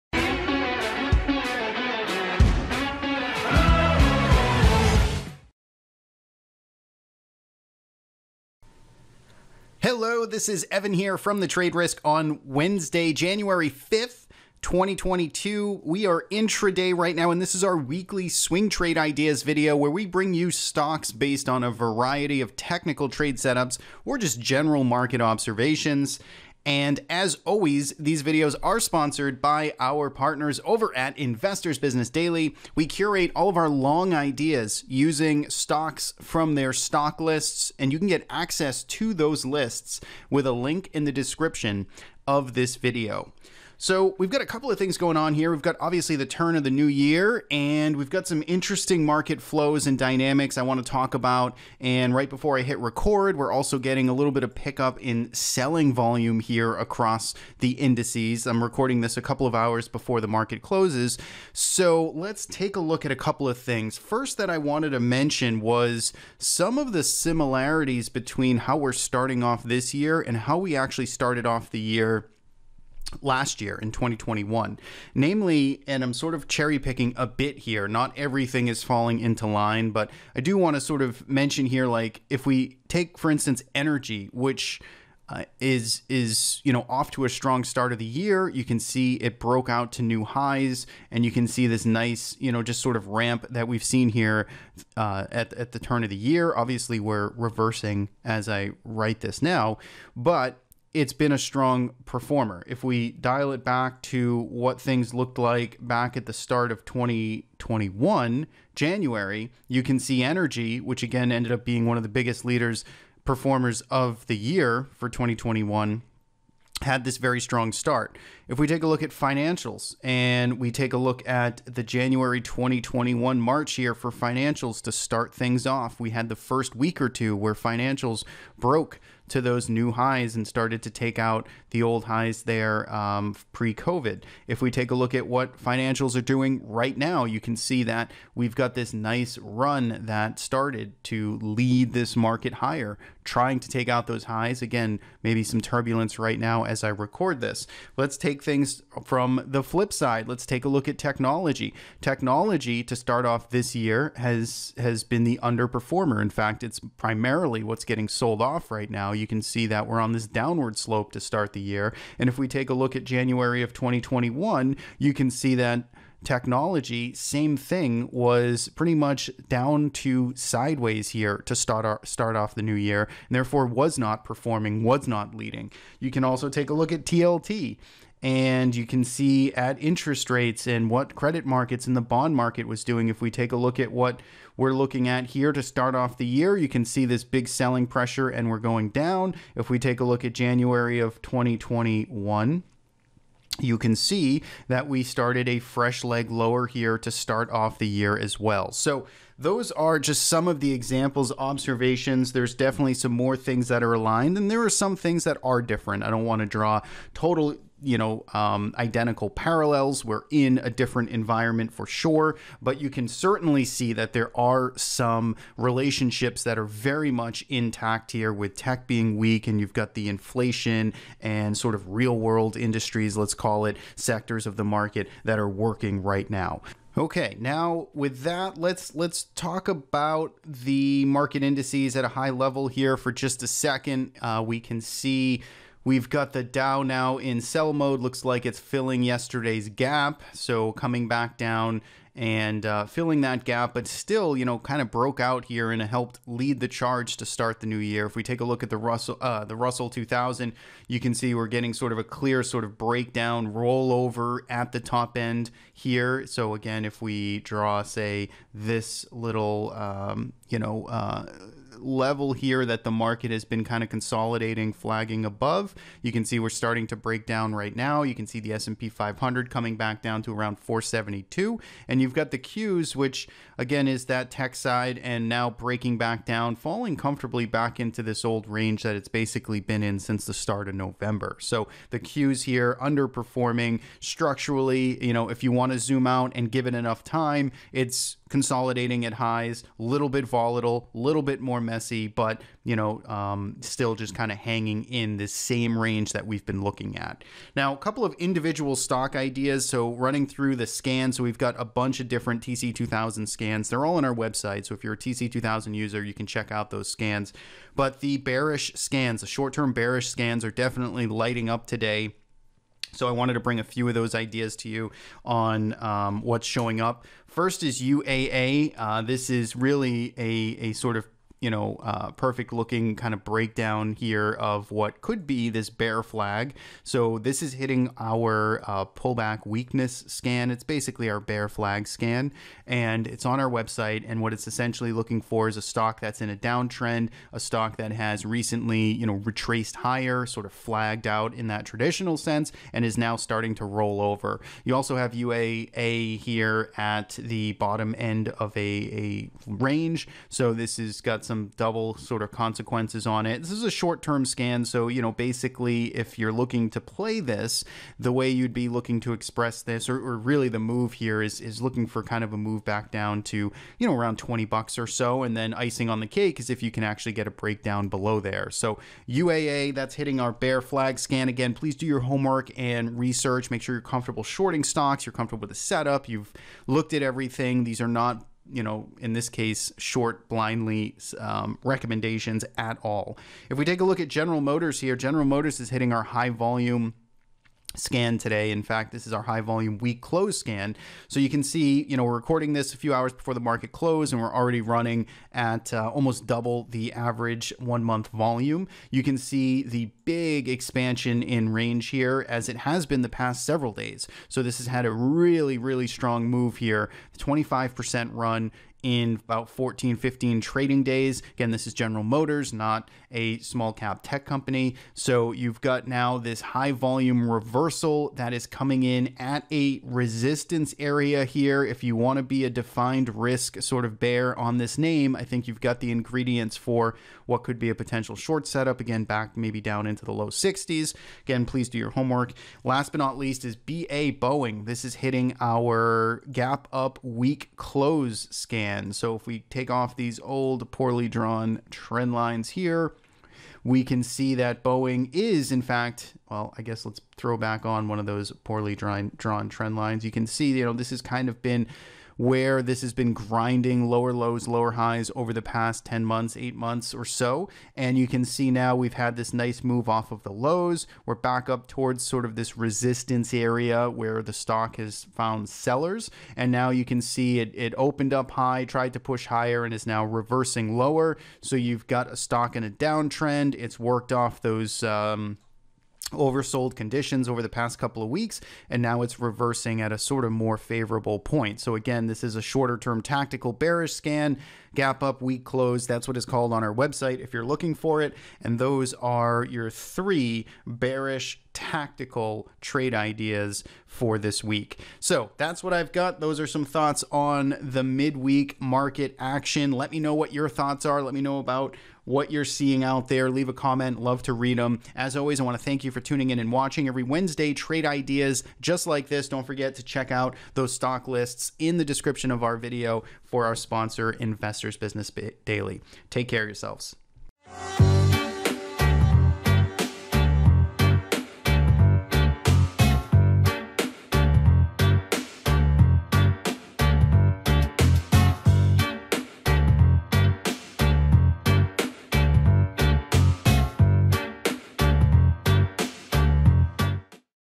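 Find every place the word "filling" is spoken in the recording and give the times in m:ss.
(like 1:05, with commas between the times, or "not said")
3:58, 4:02.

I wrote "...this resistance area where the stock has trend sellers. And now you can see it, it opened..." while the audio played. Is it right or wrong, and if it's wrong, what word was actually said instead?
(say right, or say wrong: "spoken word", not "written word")
wrong: "found", not "trend".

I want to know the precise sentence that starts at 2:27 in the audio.
Let's take things from the flip side.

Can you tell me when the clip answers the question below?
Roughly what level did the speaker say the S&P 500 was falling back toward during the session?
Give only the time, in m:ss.
4:30.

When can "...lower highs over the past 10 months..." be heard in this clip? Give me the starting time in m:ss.
7:34.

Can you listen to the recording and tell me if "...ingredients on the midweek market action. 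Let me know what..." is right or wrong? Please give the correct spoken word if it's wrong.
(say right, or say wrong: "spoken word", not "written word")
wrong: "thoughts", not "ingredients".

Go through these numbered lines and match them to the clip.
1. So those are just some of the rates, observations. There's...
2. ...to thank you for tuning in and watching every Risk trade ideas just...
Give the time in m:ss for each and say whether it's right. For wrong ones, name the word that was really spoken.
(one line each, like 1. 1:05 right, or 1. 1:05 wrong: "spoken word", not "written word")
1. 3:18 wrong: "examples", not "rates"
2. 8:25 wrong: "Wednesday", not "Risk".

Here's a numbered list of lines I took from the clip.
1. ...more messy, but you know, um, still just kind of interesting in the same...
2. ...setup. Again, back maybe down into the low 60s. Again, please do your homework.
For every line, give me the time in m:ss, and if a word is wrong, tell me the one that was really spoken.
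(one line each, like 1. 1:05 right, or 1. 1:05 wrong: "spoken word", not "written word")
1. 4:51 wrong: "hanging", not "interesting"
2. 7:08 right.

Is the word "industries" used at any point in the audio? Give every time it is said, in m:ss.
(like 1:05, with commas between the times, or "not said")
3:42.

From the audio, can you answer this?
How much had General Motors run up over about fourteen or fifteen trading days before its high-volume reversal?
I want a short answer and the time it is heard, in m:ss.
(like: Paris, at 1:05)
25%, at 6:47.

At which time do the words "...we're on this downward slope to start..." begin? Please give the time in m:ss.
2:39.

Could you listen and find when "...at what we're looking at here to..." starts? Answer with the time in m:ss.
3:03.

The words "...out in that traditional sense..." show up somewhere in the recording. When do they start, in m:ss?
5:41.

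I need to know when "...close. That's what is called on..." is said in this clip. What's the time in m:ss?
8:05.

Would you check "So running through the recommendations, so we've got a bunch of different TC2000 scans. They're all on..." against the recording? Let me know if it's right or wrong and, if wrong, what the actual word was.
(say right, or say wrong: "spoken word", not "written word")
wrong: "scans", not "recommendations".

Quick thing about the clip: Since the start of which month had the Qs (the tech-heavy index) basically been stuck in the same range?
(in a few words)
November.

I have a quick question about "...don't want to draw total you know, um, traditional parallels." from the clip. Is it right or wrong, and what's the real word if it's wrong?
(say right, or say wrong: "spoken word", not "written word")
wrong: "identical", not "traditional".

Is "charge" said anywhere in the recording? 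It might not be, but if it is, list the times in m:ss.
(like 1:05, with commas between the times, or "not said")
4:06.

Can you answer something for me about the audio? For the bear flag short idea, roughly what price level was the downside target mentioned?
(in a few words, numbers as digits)
$20.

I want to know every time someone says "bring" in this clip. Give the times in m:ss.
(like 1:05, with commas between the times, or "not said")
0:20, 5:13.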